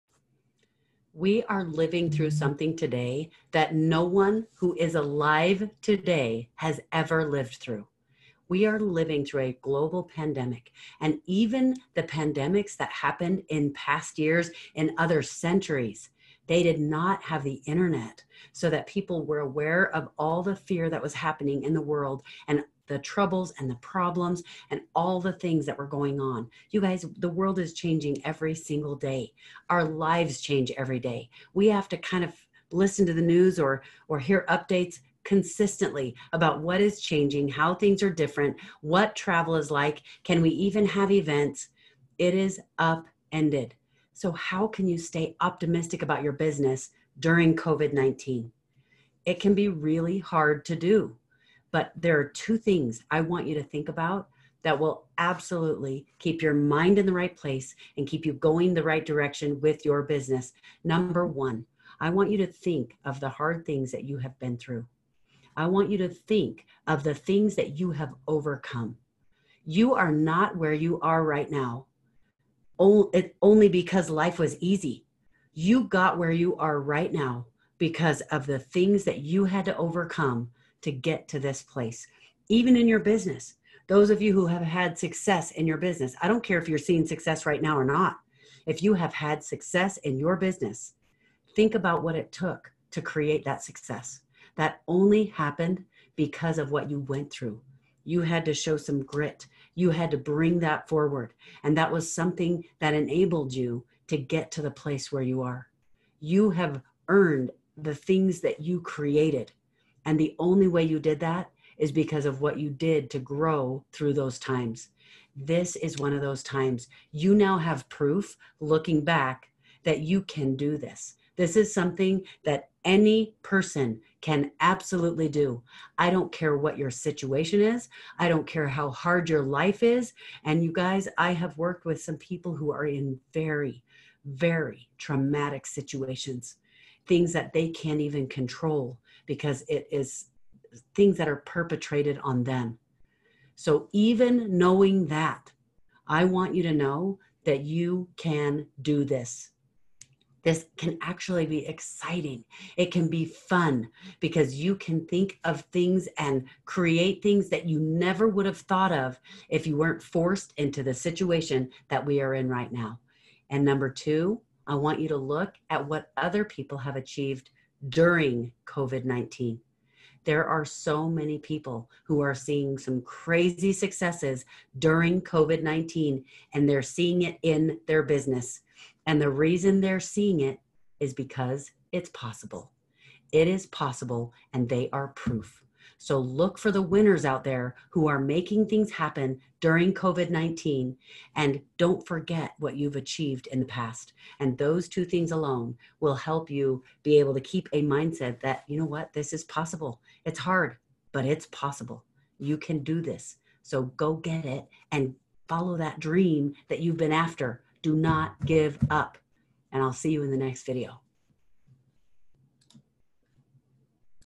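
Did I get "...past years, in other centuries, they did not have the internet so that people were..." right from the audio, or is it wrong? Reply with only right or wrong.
right.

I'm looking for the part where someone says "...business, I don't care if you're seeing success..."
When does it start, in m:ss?
1:25.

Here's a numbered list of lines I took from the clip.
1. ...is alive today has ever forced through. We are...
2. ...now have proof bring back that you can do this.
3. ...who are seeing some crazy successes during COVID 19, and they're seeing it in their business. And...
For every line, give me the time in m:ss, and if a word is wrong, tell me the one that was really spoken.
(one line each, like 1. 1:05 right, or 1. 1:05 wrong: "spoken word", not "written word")
1. 0:04 wrong: "lived", not "forced"
2. 1:57 wrong: "looking", not "bring"
3. 2:52 right.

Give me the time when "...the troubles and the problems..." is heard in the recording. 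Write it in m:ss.
0:22.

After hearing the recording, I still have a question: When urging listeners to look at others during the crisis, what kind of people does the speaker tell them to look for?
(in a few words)
the winners.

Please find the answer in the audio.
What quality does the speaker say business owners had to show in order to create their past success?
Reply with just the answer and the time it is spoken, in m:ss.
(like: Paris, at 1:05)
grit, at 1:39.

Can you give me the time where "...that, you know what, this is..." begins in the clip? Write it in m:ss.
3:18.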